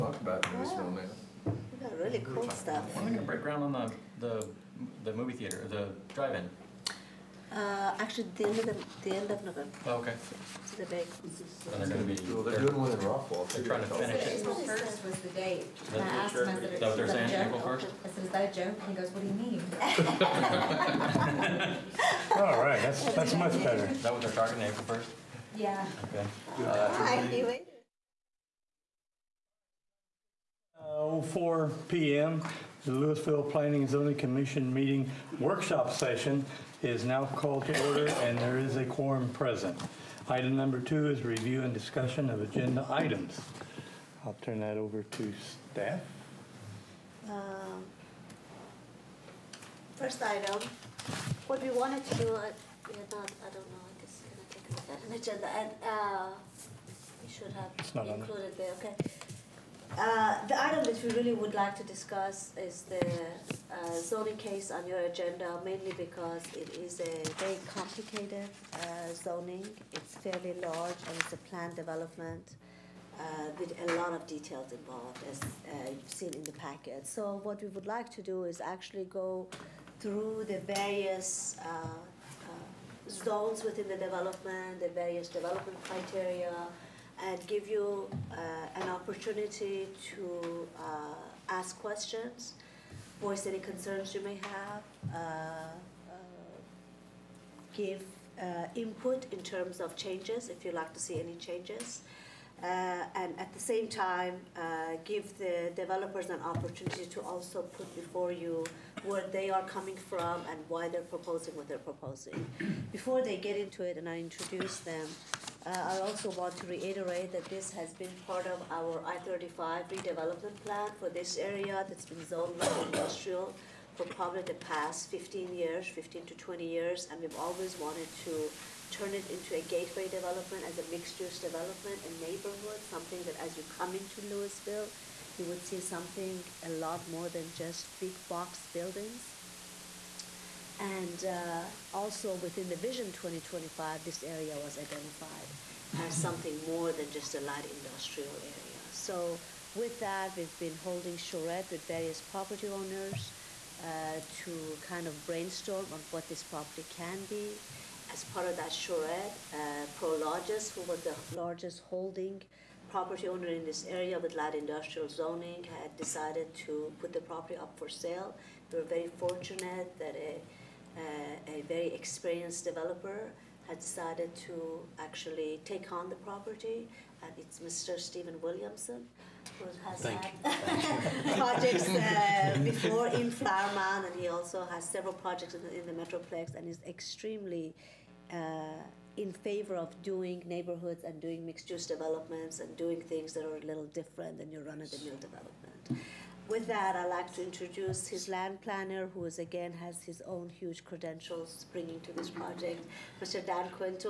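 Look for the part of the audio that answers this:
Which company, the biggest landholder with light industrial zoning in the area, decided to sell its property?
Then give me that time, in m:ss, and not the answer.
2:39.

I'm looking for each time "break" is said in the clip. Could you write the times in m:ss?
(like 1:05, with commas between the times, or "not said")
0:03.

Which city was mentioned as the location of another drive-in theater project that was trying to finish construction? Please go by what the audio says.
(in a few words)
Rockwall.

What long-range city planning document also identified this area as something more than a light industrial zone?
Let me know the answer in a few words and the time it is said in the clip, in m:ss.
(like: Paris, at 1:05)
Vision 2025, at 2:22.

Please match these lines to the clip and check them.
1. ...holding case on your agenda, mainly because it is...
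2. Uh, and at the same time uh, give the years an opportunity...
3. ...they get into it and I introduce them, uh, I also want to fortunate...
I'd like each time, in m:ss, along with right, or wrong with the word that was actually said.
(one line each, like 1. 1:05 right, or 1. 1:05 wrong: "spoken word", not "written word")
1. 1:03 wrong: "zoning", not "holding"
2. 1:42 wrong: "developers", not "years"
3. 1:53 wrong: "reiterate", not "fortunate".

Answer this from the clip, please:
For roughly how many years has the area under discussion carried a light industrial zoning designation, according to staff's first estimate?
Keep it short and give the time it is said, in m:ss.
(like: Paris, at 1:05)
15 years, at 2:05.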